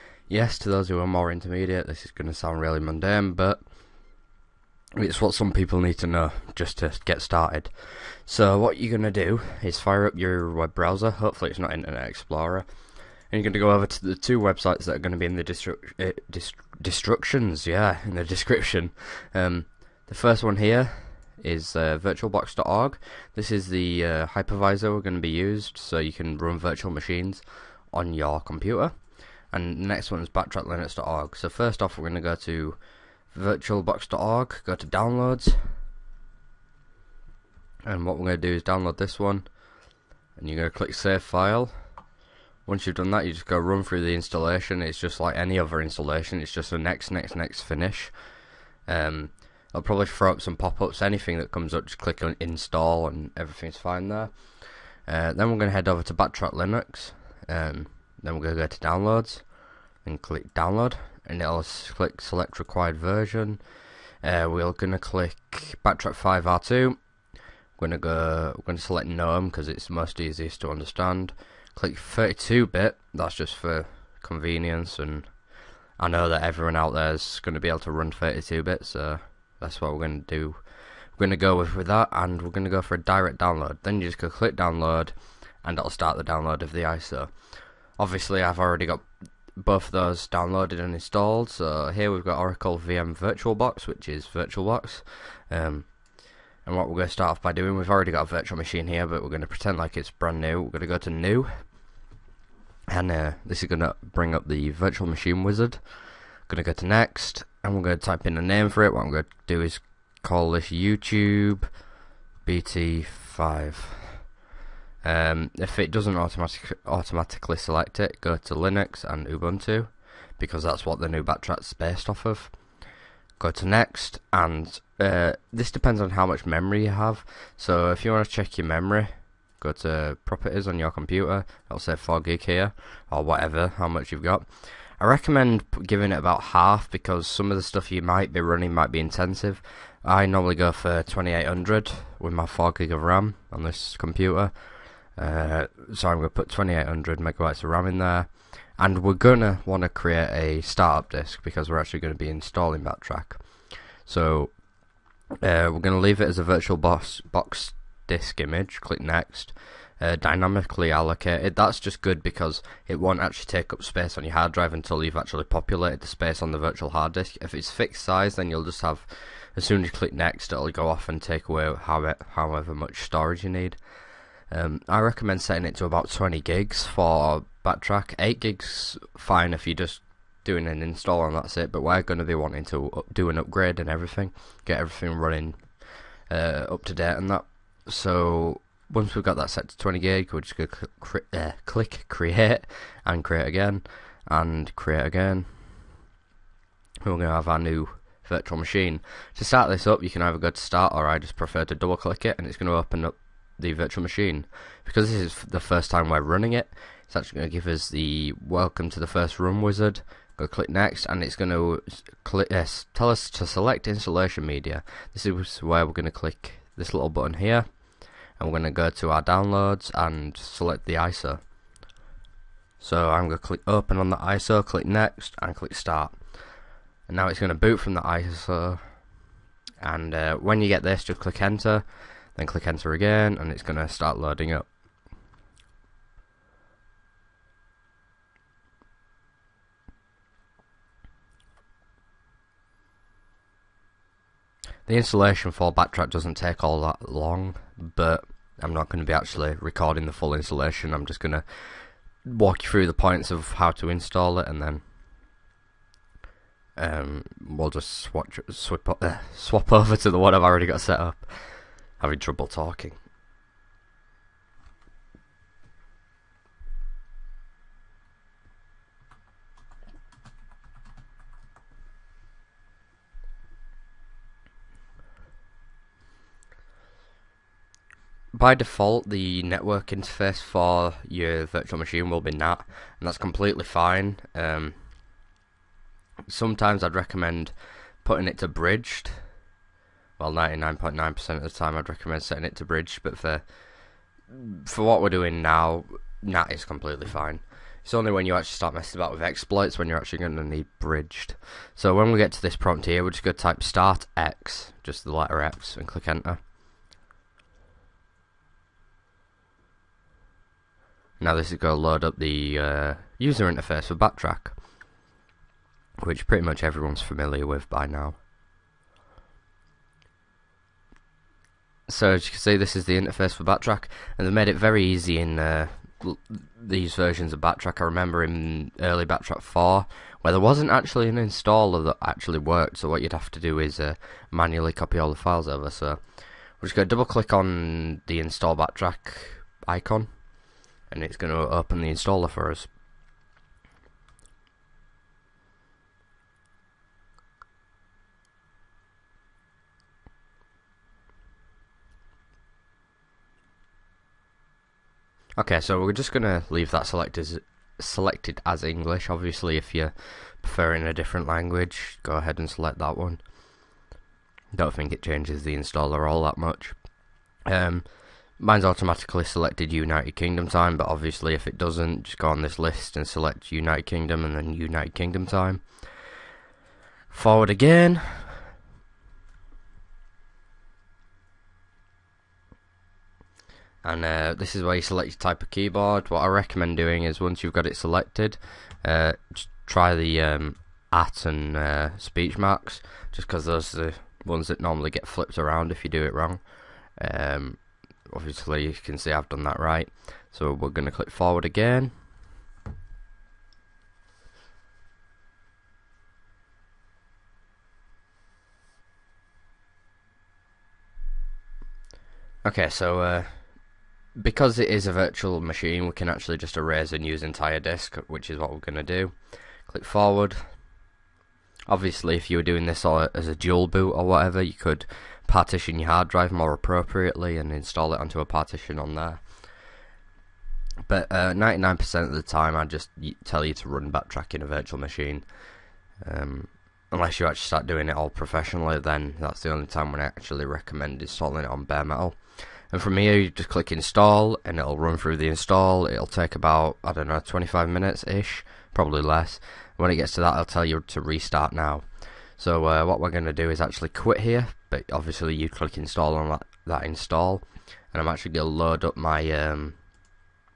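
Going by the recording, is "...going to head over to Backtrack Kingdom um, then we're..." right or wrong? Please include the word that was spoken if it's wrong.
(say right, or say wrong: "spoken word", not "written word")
wrong: "Linux", not "Kingdom".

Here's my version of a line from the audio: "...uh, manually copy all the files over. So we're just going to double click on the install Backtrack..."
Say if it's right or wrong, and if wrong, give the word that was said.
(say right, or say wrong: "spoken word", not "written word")
right.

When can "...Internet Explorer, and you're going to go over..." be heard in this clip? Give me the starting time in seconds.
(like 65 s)
11 s.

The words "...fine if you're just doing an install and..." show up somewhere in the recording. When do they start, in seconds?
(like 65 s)
179 s.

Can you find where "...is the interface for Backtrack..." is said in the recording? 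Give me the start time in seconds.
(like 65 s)
322 s.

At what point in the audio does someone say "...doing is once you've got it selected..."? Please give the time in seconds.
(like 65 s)
386 s.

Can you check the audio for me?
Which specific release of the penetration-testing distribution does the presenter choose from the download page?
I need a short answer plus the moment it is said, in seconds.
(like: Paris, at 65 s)
Backtrack 5R2, at 65 s.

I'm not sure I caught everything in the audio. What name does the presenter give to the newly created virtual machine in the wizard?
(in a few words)
YouTube BT5.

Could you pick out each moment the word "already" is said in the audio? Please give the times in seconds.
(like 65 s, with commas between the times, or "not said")
88 s, 97 s, 260 s.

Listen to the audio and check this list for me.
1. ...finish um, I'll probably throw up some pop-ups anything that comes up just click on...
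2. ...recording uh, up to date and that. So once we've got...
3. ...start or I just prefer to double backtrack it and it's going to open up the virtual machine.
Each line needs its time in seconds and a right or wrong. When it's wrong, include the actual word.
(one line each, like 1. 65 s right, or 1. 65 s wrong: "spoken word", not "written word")
1. 47 s right
2. 185 s wrong: "running", not "recording"
3. 200 s wrong: "click", not "backtrack".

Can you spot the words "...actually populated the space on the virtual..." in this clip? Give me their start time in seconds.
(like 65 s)
165 s.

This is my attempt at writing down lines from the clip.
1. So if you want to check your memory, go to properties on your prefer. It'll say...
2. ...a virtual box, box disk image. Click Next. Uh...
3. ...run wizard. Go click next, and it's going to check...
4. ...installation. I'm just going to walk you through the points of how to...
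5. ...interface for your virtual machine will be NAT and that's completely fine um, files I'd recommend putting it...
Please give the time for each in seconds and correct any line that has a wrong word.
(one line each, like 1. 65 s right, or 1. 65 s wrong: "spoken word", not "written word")
1. 127 s wrong: "computer", not "prefer"
2. 156 s right
3. 209 s wrong: "click", not "check"
4. 250 s right
5. 279 s wrong: "sometimes", not "files".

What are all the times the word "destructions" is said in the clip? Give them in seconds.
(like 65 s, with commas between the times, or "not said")
16 s.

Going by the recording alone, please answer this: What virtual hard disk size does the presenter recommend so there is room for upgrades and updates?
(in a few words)
20 gigs.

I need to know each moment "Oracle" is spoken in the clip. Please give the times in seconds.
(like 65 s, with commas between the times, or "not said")
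92 s.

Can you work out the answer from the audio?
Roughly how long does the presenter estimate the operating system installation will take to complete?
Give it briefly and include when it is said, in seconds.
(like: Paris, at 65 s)
25 minutes, at 447 s.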